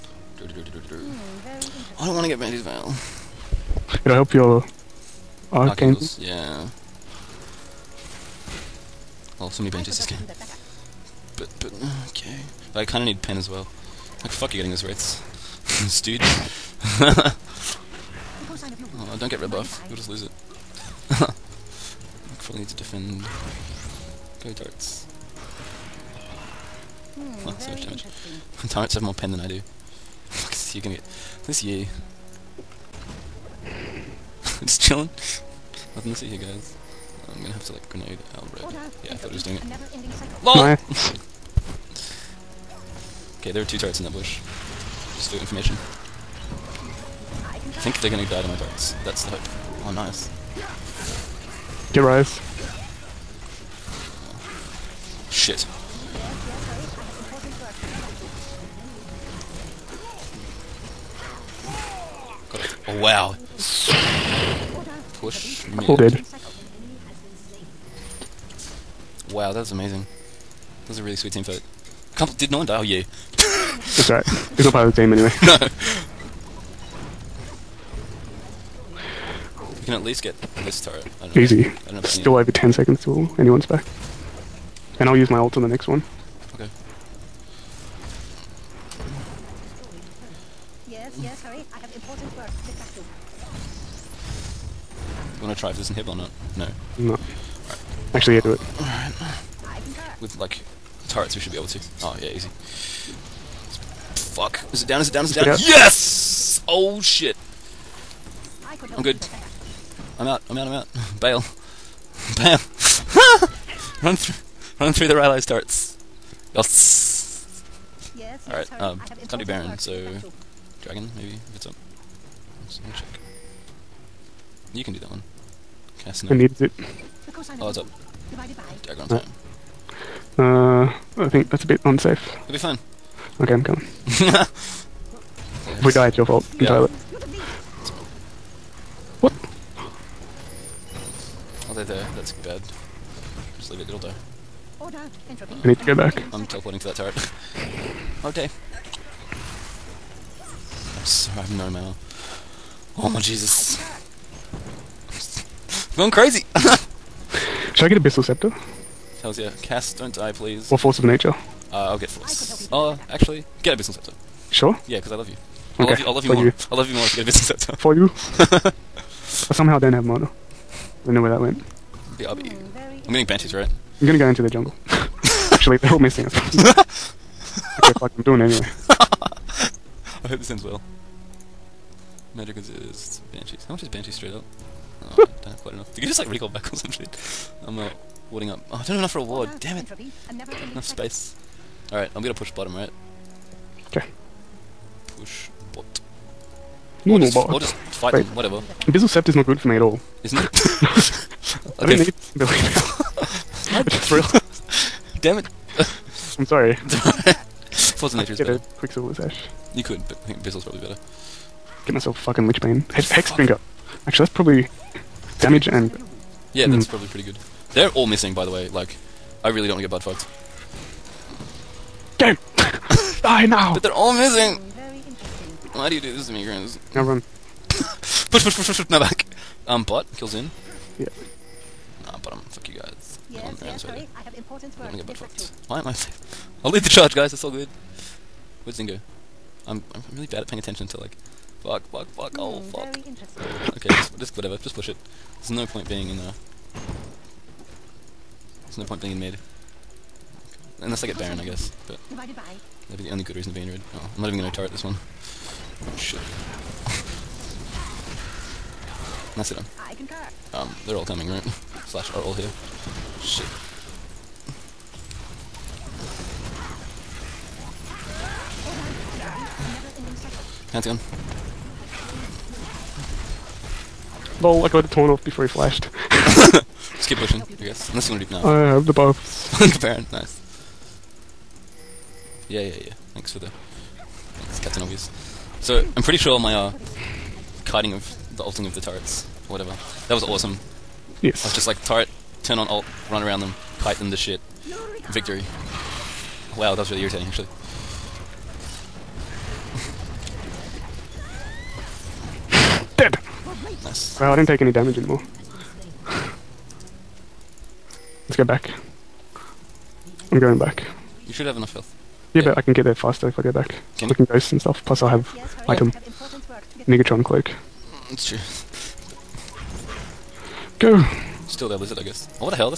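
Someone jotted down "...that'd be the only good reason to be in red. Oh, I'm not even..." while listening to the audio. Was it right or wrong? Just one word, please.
right.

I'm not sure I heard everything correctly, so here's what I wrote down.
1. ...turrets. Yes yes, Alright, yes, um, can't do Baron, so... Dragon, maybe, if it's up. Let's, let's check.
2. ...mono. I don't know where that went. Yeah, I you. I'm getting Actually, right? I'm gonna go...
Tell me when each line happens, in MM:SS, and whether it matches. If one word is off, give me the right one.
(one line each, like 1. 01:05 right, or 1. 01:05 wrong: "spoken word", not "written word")
1. 01:55 right
2. 02:50 wrong: "Banshees", not "Actually".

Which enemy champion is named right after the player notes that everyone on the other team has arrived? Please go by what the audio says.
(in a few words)
Pantheon.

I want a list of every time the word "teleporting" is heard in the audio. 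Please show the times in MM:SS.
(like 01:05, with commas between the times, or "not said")
02:26.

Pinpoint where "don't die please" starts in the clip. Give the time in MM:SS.
02:39.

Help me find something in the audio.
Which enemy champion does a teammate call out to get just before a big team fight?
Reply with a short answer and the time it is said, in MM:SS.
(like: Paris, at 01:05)
Ryze, at 00:51.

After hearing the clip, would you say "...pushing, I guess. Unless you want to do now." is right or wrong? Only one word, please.
right.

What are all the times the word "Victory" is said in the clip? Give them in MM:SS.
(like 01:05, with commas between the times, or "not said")
04:55.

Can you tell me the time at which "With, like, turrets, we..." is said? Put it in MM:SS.
01:40.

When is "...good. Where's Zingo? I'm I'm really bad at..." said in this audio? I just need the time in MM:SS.
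03:57.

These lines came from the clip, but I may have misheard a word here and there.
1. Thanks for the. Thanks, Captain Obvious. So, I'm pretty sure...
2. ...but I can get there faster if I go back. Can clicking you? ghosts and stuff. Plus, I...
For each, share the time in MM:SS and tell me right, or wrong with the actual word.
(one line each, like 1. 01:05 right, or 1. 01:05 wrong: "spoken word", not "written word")
1. 04:43 right
2. 05:12 right.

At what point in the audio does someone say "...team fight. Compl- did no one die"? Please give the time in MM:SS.
01:11.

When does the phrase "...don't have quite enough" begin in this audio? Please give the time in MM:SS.
03:05.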